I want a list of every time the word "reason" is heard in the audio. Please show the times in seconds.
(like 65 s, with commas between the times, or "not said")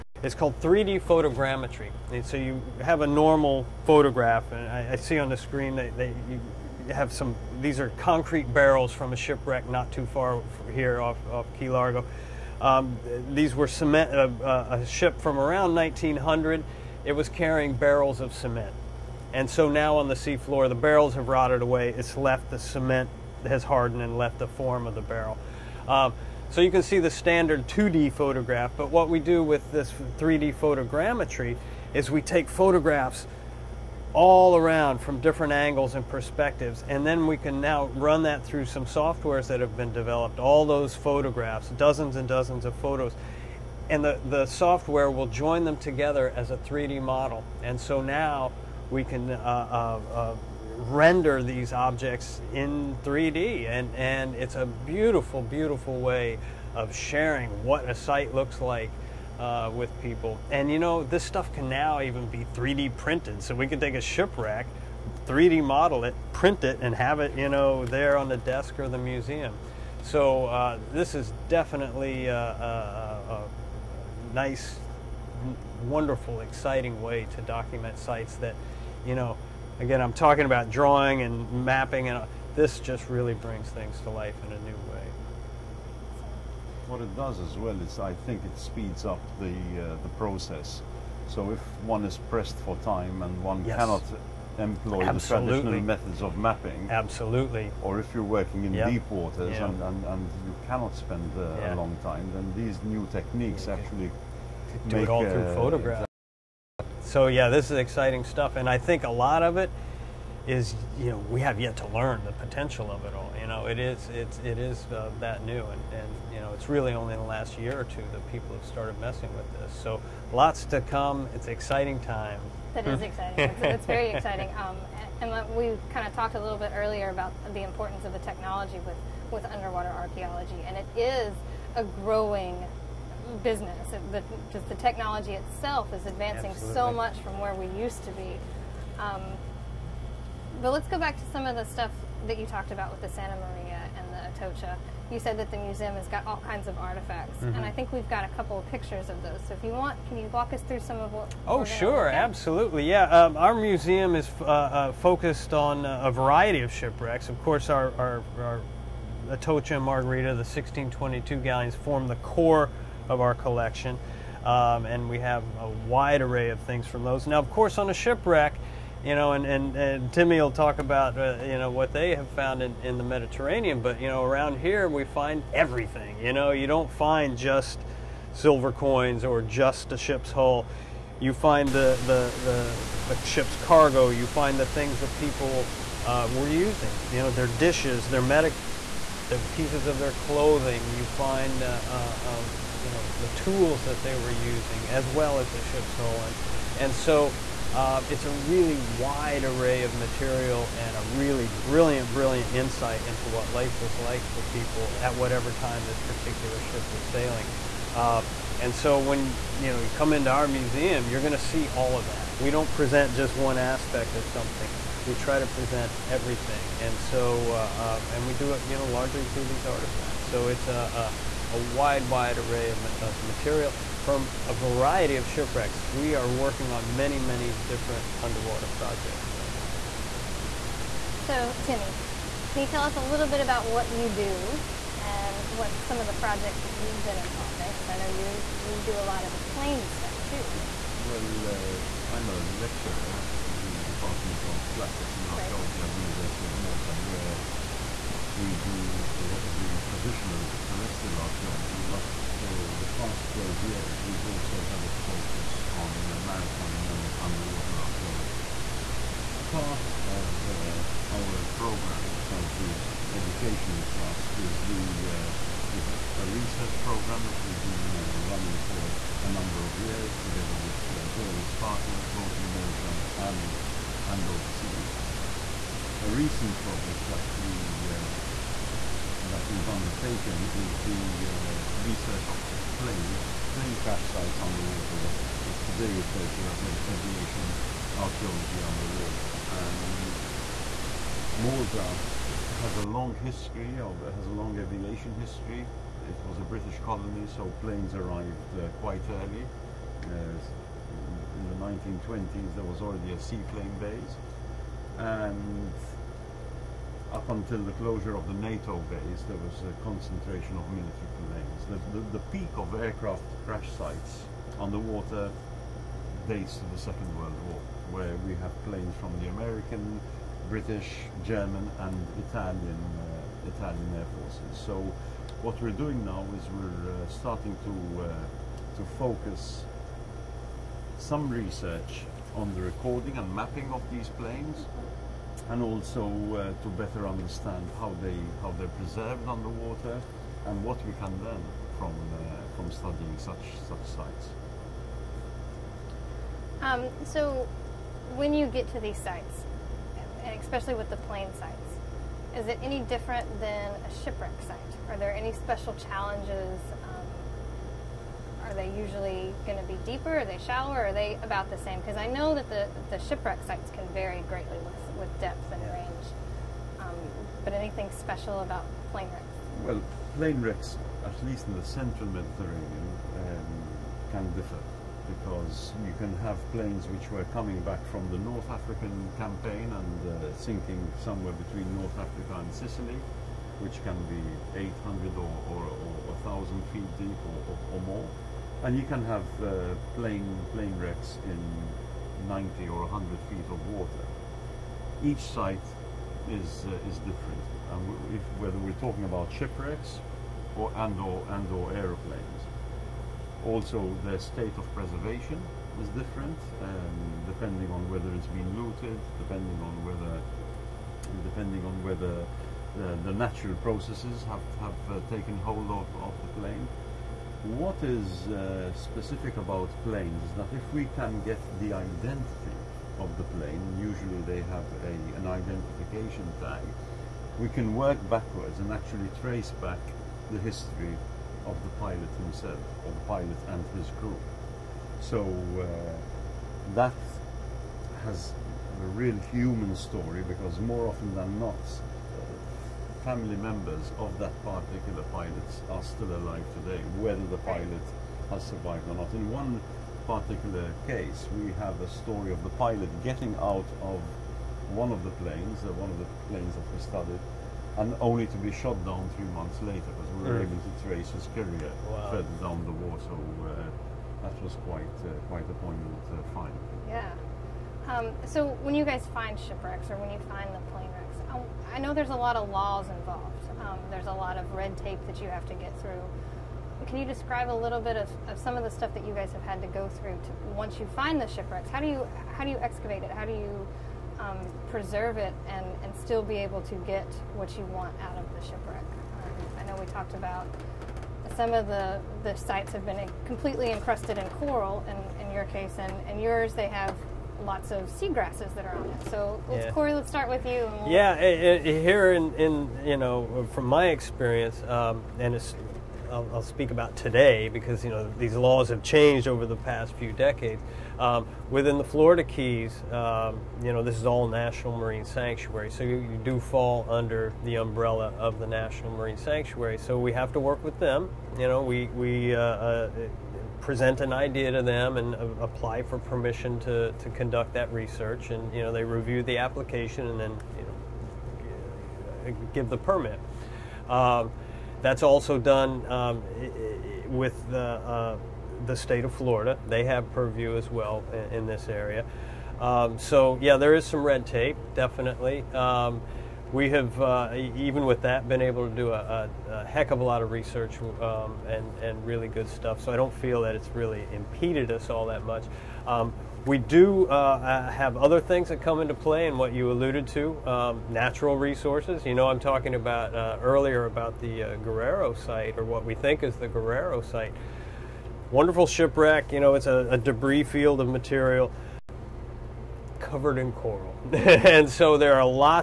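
not said.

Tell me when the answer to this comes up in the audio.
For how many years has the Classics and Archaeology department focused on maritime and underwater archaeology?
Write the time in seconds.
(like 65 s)
253 s.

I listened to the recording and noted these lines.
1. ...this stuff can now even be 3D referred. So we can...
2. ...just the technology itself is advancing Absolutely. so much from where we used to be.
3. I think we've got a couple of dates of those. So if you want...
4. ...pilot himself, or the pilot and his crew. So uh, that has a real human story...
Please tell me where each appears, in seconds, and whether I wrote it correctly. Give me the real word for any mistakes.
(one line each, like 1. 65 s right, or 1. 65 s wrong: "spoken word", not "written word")
1. 61 s wrong: "printed", not "referred"
2. 134 s right
3. 147 s wrong: "pictures", not "dates"
4. 431 s right.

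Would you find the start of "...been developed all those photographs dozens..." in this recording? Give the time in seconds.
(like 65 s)
39 s.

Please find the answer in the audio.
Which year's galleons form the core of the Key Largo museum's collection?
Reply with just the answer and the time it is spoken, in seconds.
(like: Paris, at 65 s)
1622, at 160 s.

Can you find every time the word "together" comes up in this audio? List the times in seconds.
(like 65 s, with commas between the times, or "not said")
45 s, 270 s.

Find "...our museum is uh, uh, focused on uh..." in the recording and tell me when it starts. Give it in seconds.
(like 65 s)
153 s.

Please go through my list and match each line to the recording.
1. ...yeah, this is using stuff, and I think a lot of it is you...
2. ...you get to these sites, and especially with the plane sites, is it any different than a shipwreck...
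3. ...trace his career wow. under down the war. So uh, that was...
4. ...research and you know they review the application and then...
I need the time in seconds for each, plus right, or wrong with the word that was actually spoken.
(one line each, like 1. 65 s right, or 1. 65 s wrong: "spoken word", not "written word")
1. 107 s wrong: "exciting", not "using"
2. 348 s right
3. 460 s wrong: "further", not "under"
4. 527 s right.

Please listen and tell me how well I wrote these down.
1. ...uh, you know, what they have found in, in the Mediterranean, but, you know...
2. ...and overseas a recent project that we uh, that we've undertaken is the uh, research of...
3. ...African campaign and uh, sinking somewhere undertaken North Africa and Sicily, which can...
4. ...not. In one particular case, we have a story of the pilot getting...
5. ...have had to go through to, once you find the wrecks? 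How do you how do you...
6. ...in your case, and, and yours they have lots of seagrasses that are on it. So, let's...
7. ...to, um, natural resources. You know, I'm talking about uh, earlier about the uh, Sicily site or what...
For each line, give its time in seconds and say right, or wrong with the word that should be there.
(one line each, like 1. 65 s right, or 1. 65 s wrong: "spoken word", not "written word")
1. 171 s right
2. 274 s right
3. 378 s wrong: "between", not "undertaken"
4. 448 s right
5. 479 s wrong: "shipwrecks", not "wrecks"
6. 495 s right
7. 560 s wrong: "Guerrero", not "Sicily".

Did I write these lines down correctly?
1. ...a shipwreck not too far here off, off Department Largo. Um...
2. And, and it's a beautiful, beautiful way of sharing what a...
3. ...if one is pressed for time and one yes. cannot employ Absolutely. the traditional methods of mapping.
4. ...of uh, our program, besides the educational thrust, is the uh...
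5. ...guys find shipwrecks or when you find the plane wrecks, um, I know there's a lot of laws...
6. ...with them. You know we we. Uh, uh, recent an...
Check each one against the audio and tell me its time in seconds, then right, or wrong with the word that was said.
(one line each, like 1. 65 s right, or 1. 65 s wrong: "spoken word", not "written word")
1. 9 s wrong: "Key", not "Department"
2. 53 s right
3. 91 s right
4. 260 s right
5. 468 s right
6. 520 s wrong: "present", not "recent".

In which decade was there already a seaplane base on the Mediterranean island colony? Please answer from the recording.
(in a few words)
1920s.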